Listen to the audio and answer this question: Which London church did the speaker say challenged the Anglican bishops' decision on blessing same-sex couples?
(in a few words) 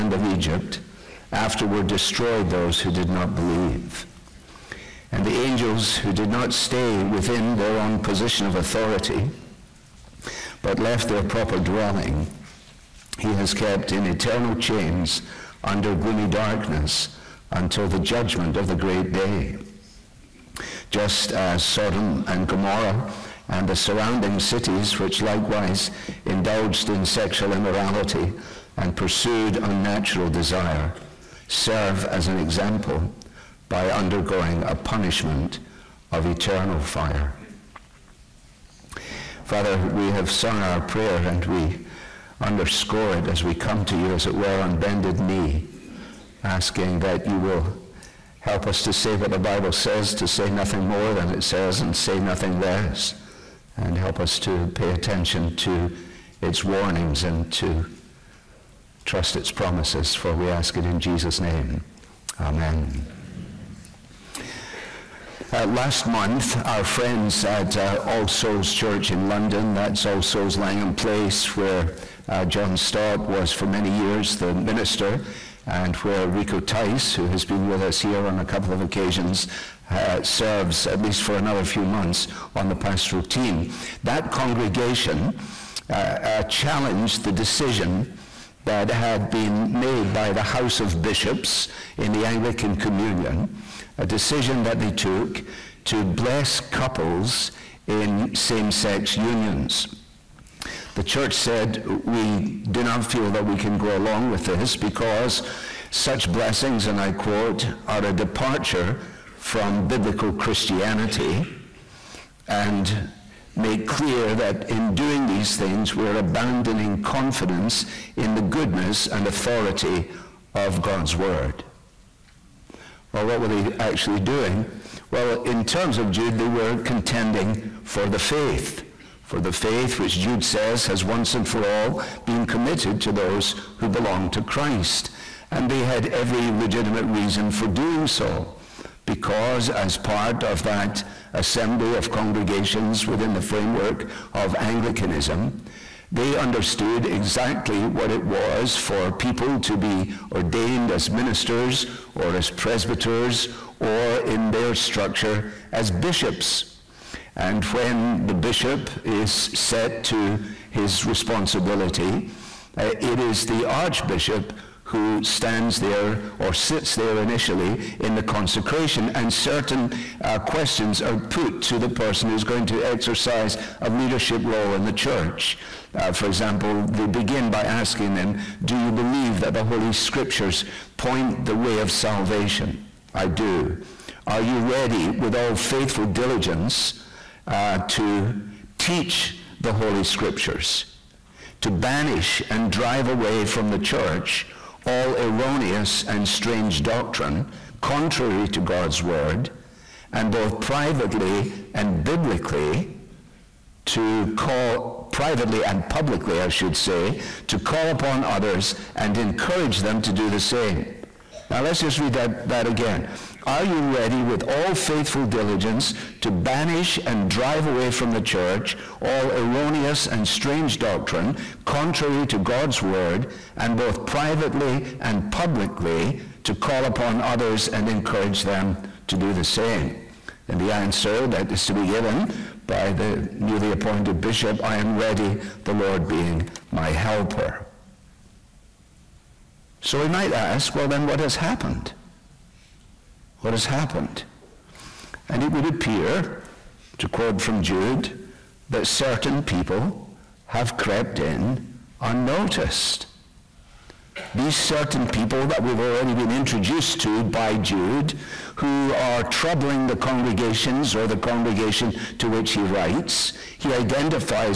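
All Souls Langham Place.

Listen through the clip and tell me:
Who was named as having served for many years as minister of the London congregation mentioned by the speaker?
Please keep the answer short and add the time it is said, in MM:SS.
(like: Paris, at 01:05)
John Stott, at 01:12.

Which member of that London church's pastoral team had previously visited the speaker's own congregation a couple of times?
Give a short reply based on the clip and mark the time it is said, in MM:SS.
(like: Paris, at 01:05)
Rico Tice, at 01:16.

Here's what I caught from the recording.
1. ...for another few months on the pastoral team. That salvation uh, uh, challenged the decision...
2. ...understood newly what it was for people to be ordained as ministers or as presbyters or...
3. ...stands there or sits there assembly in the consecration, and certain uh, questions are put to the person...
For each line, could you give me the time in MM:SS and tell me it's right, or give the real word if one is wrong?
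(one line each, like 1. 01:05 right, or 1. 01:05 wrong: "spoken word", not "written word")
1. 01:21 wrong: "congregation", not "salvation"
2. 02:26 wrong: "exactly", not "newly"
3. 02:45 wrong: "initially", not "assembly".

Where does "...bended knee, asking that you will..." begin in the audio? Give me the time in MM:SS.
00:44.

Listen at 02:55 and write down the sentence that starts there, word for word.
Uh, for example, they begin by asking them, Do you believe that the Holy Scriptures point the way of salvation?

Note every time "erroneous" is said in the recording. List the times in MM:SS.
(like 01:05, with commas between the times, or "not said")
03:15, 03:39.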